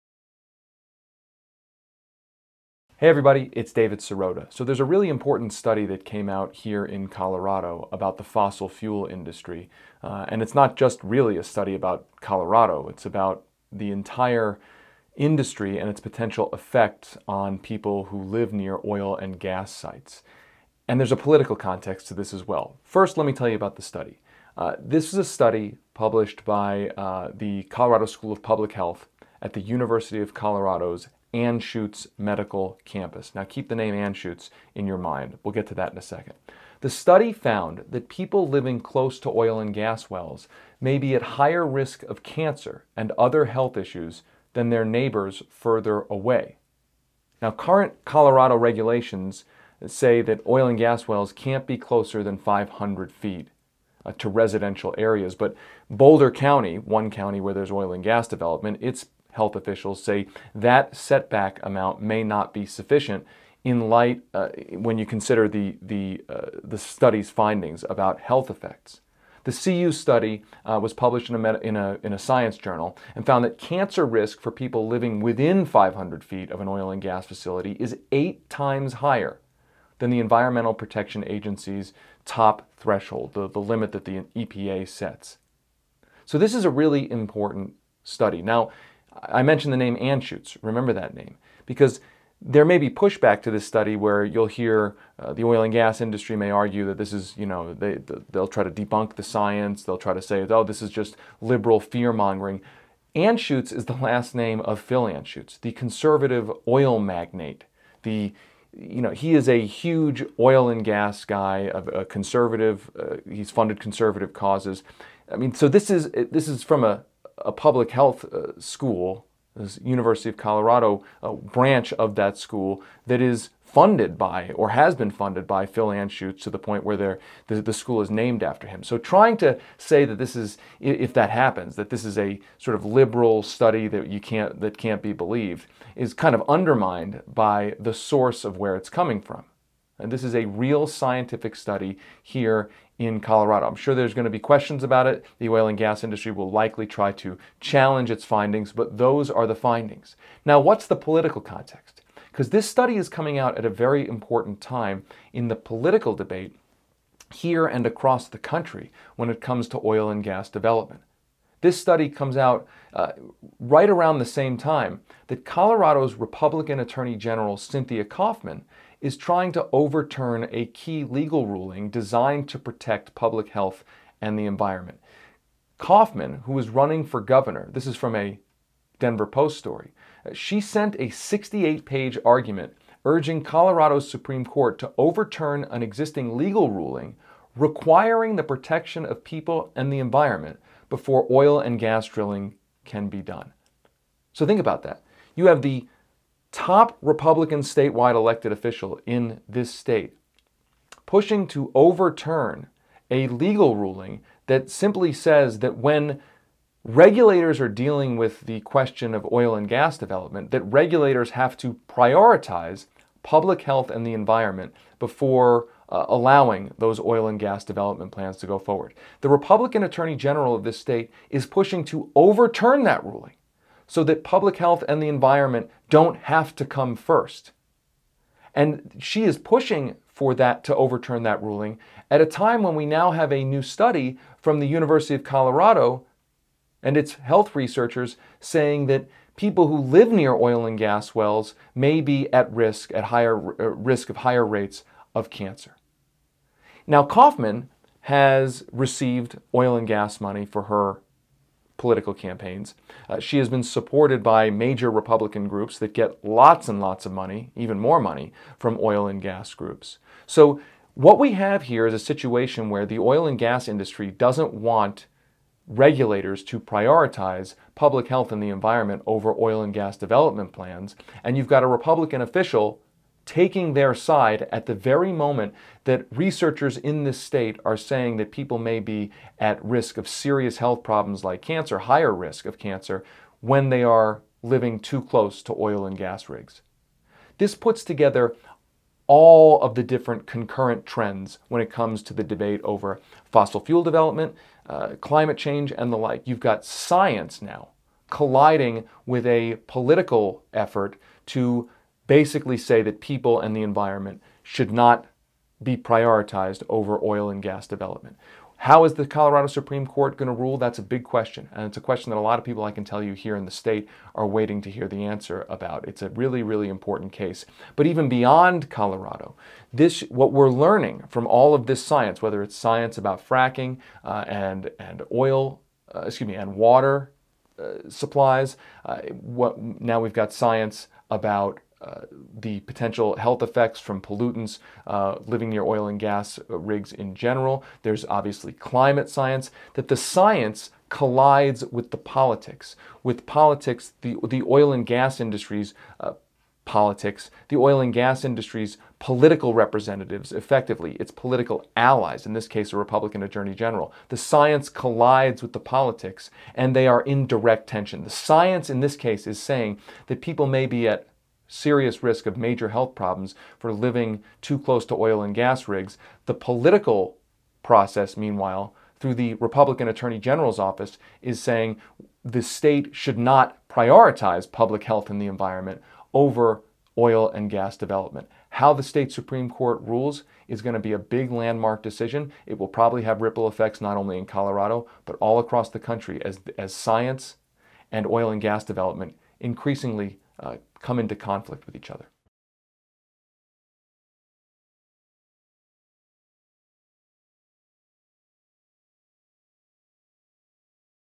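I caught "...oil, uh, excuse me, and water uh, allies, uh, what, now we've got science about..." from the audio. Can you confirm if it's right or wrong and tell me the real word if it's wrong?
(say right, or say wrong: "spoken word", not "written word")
wrong: "supplies", not "allies".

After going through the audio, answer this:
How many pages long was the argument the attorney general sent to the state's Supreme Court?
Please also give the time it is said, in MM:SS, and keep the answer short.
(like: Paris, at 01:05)
68, at 03:01.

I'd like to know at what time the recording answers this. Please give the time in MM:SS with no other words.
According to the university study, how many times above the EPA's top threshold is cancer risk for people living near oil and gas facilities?
01:18.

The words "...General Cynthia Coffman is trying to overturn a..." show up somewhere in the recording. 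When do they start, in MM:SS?
02:47.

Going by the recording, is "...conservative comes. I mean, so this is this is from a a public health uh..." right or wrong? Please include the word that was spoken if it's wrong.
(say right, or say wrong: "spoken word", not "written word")
wrong: "causes", not "comes".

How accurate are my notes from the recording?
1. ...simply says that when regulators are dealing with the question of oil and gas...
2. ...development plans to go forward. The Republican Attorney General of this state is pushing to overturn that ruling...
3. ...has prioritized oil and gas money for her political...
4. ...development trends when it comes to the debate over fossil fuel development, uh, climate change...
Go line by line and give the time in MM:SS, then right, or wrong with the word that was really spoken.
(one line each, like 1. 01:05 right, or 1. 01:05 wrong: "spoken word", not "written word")
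1. 03:24 right
2. 03:37 right
3. 04:08 wrong: "received", not "prioritized"
4. 04:50 wrong: "concurrent", not "development".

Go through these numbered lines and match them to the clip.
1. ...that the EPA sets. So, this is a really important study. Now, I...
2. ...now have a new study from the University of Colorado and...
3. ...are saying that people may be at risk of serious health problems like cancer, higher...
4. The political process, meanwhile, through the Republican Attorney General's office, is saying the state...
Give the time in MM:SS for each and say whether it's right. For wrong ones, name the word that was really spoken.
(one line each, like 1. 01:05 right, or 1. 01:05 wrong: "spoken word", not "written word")
1. 01:23 right
2. 03:52 right
3. 04:37 right
4. 06:06 right.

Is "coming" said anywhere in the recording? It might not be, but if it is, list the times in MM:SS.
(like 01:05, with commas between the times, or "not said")
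02:18, 02:33.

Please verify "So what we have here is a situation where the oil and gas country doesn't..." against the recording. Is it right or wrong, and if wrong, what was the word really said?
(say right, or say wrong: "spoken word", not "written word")
wrong: "industry", not "country".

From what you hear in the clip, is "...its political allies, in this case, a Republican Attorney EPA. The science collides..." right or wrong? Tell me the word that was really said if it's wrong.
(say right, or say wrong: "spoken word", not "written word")
wrong: "General", not "EPA".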